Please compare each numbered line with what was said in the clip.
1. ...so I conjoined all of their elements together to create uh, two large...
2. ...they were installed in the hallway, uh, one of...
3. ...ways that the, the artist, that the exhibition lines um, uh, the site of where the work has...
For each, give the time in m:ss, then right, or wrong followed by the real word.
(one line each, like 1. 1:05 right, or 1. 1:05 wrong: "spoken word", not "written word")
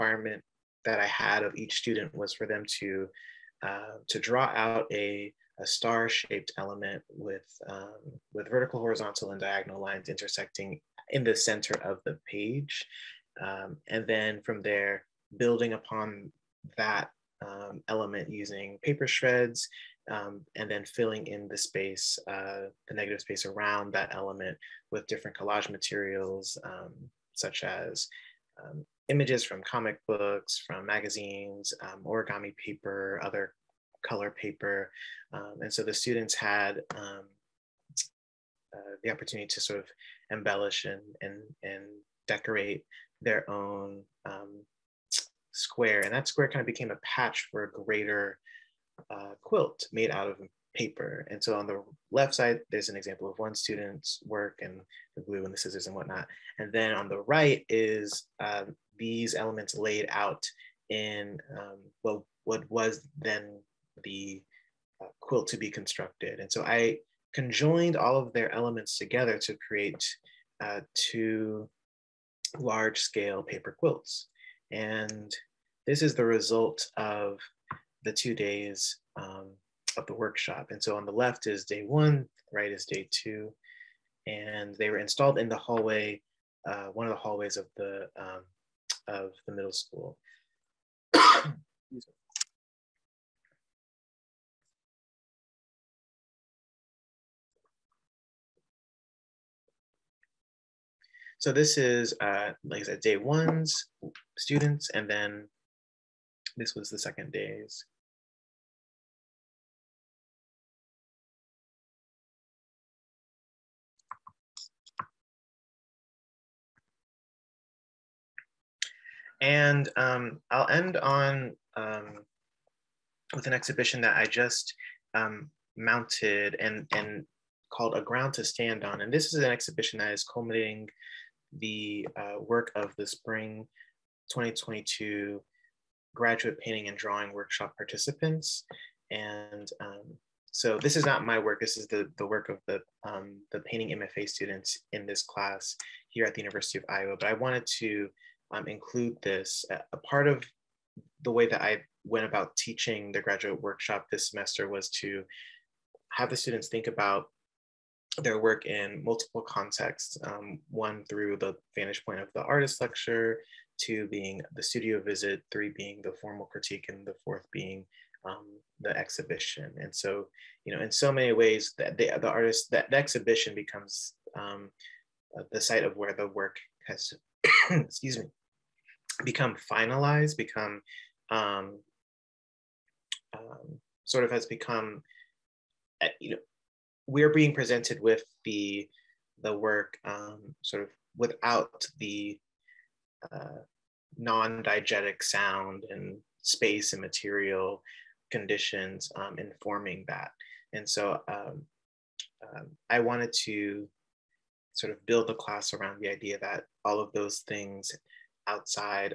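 1. 1:06 right
2. 1:24 right
3. 2:51 wrong: "becomes", not "lines".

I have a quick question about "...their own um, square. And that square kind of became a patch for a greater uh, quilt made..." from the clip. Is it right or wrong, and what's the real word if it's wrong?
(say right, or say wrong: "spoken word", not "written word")
right.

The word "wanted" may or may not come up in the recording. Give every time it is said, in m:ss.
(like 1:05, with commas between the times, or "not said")
2:27, 3:23.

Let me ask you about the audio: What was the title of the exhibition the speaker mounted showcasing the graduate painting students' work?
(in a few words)
A Ground to Stand On.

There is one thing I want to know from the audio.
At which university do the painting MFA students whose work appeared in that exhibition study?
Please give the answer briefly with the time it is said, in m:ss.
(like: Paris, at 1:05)
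University of Iowa, at 2:26.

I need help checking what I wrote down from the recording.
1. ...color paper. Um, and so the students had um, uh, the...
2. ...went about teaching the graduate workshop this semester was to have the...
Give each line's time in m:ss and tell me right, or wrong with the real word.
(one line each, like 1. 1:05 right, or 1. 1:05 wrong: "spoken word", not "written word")
1. 0:34 right
2. 2:32 right.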